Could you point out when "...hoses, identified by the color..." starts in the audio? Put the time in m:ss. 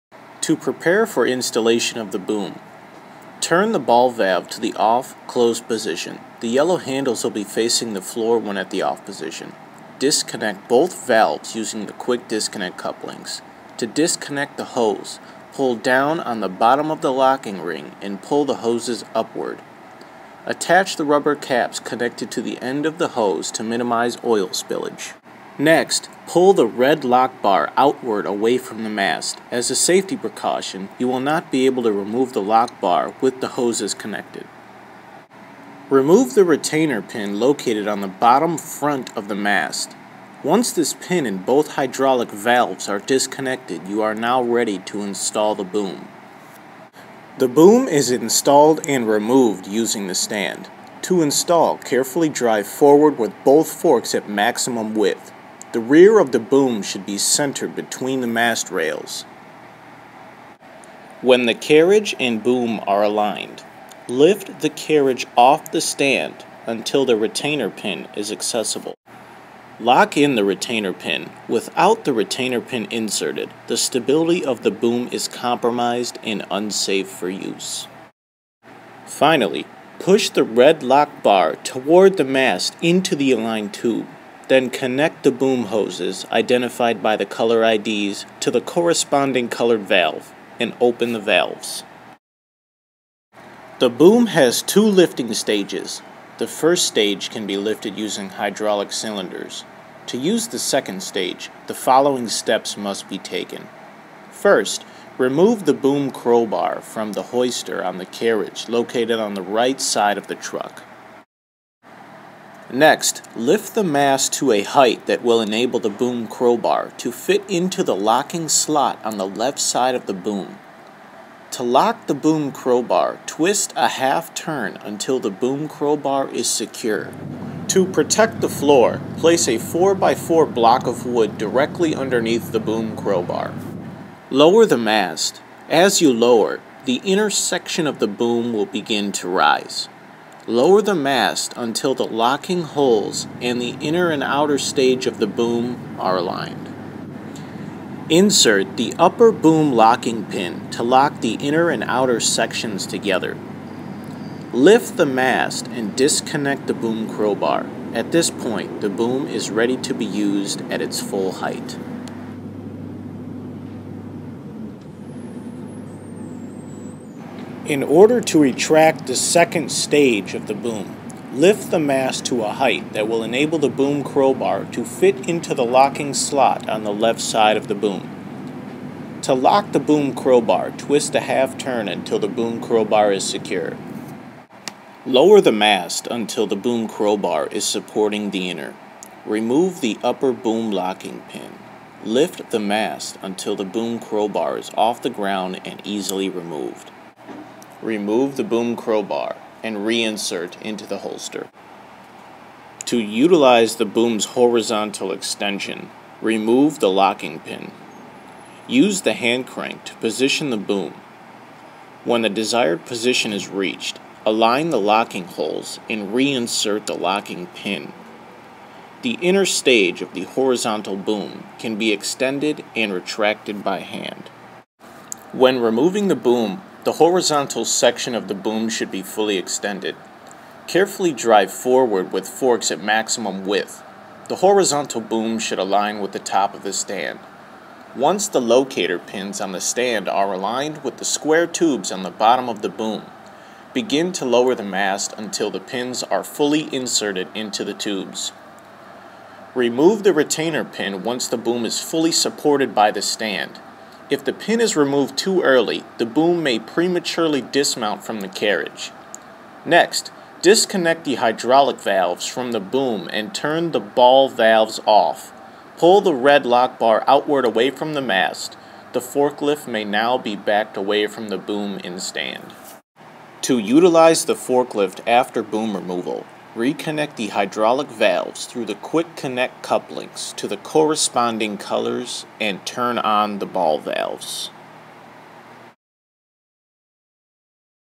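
1:25.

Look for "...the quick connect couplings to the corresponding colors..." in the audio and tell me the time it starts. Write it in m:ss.
4:38.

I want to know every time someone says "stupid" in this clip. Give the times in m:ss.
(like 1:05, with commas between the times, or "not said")
not said.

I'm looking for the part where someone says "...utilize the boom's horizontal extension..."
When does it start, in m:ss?
3:22.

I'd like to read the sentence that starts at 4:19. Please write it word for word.
Next, disconnect the hydraulic valves from the boom and turn the ball valves off.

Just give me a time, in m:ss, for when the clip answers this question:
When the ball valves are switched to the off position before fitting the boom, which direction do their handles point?
0:07.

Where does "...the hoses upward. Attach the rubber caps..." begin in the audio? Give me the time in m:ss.
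0:18.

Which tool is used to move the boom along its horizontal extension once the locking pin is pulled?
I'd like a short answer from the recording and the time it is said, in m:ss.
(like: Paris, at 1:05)
Hand crank, at 3:29.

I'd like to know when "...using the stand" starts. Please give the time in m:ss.
0:49.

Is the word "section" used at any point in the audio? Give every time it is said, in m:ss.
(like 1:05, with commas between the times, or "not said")
2:17, 2:32, 3:47.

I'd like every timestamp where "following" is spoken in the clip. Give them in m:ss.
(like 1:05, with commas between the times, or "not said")
1:41.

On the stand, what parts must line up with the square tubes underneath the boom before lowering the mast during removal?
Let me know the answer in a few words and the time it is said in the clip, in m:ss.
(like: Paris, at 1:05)
Locator pins, at 3:58.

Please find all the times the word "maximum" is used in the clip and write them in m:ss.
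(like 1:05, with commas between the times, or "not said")
0:54, 3:52.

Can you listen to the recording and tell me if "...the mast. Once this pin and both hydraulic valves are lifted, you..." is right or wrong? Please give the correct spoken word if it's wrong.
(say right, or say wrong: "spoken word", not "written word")
wrong: "disconnected", not "lifted".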